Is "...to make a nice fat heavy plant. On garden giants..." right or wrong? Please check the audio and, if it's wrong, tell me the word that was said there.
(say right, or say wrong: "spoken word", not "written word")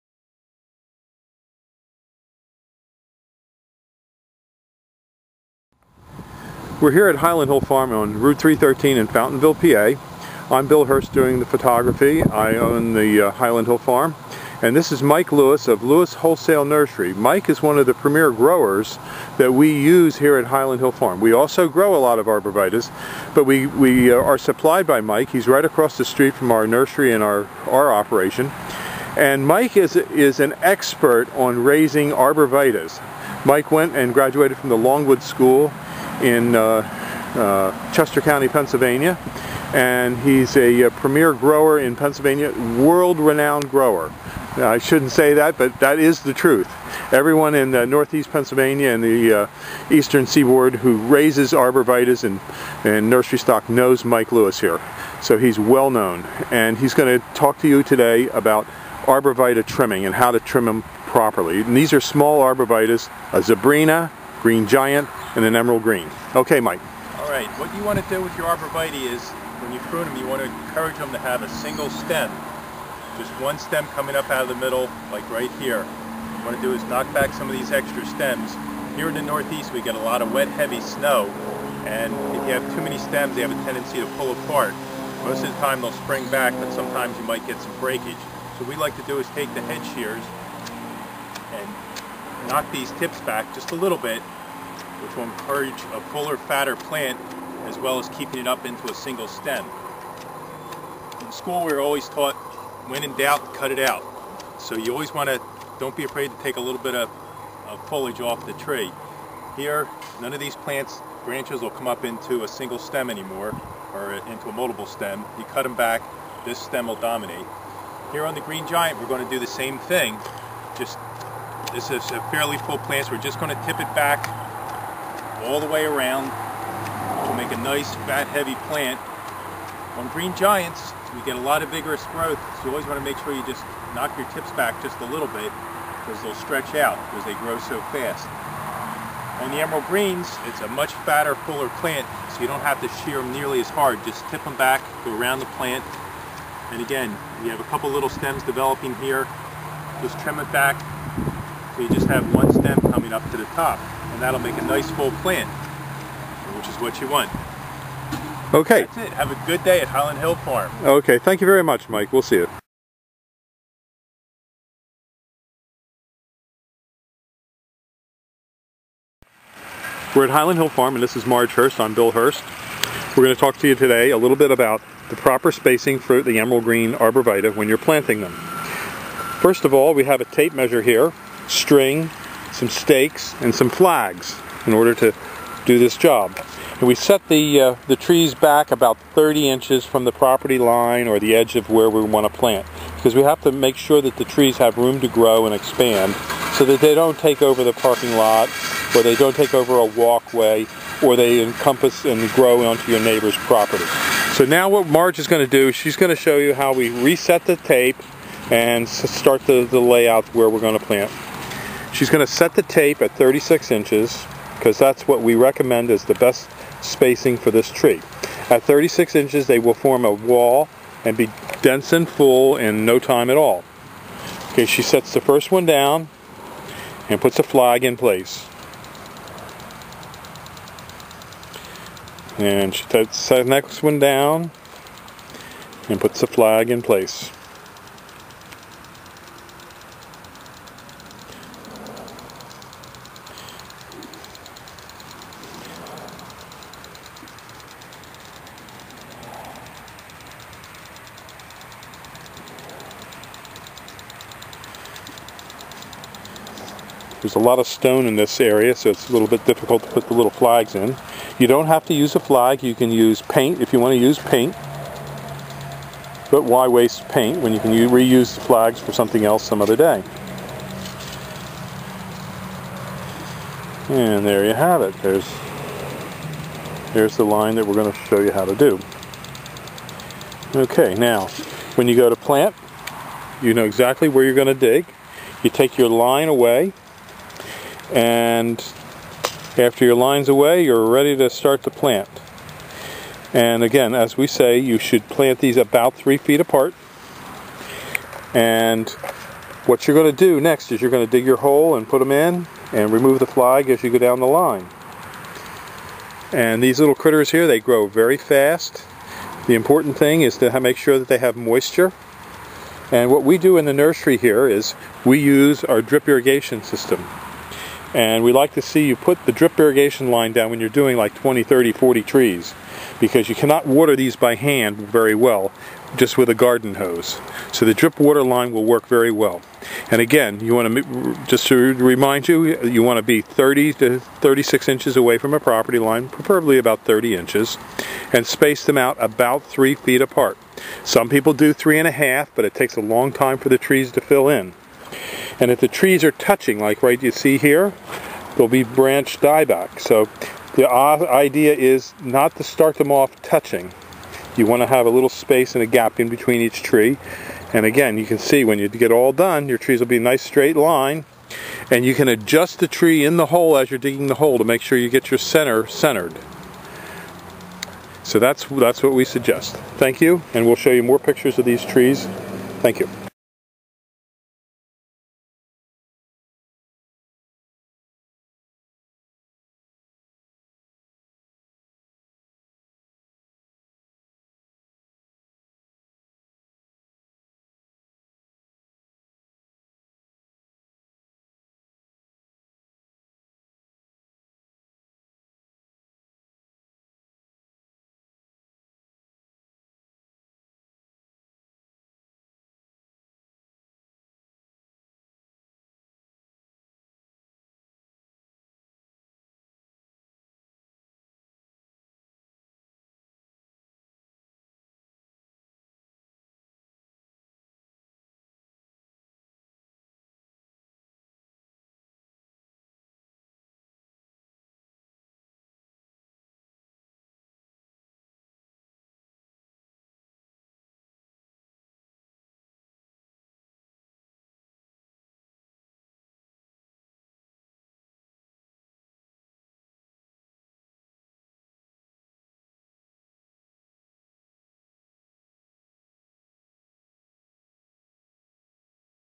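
wrong: "green", not "garden".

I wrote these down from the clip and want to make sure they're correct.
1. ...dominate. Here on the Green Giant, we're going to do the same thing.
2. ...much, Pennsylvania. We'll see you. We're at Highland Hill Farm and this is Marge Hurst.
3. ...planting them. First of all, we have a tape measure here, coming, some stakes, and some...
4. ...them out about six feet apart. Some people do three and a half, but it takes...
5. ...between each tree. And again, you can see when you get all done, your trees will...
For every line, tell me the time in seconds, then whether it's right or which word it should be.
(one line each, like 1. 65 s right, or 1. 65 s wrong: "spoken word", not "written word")
1. 116 s right
2. 161 s wrong: "Mike", not "Pennsylvania"
3. 177 s wrong: "string", not "coming"
4. 338 s wrong: "three", not "six"
5. 356 s right.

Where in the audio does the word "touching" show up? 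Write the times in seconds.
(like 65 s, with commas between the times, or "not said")
346 s, 353 s.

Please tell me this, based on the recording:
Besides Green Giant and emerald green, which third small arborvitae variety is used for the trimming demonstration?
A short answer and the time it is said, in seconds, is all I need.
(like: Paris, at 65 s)
Zebrina, at 63 s.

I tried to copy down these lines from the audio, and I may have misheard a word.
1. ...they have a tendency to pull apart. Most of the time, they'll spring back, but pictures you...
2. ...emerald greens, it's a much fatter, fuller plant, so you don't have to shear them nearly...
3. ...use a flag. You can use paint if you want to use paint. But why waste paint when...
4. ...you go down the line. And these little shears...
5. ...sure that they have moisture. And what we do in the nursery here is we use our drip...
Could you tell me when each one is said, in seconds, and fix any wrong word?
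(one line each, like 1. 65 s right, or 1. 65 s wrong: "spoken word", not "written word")
1. 83 s wrong: "sometimes", not "pictures"
2. 139 s right
3. 261 s right
4. 303 s wrong: "critters", not "shears"
5. 310 s right.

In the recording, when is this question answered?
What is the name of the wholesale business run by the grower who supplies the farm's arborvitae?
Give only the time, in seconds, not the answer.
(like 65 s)
15 s.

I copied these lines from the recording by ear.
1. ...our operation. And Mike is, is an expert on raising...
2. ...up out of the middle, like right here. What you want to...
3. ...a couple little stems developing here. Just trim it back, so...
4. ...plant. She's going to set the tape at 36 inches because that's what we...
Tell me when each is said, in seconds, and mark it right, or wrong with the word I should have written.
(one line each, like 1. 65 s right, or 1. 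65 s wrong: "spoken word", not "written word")
1. 27 s right
2. 74 s right
3. 147 s right
4. 210 s right.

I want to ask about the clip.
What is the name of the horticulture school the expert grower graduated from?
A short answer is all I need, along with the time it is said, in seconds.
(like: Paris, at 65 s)
Longwood School, at 34 s.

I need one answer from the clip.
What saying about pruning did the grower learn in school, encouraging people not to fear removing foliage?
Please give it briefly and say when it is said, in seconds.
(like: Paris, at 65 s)
When in doubt, cut it out, at 102 s.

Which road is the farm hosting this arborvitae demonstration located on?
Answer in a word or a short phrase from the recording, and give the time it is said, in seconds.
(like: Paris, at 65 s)
Route 313, at 8 s.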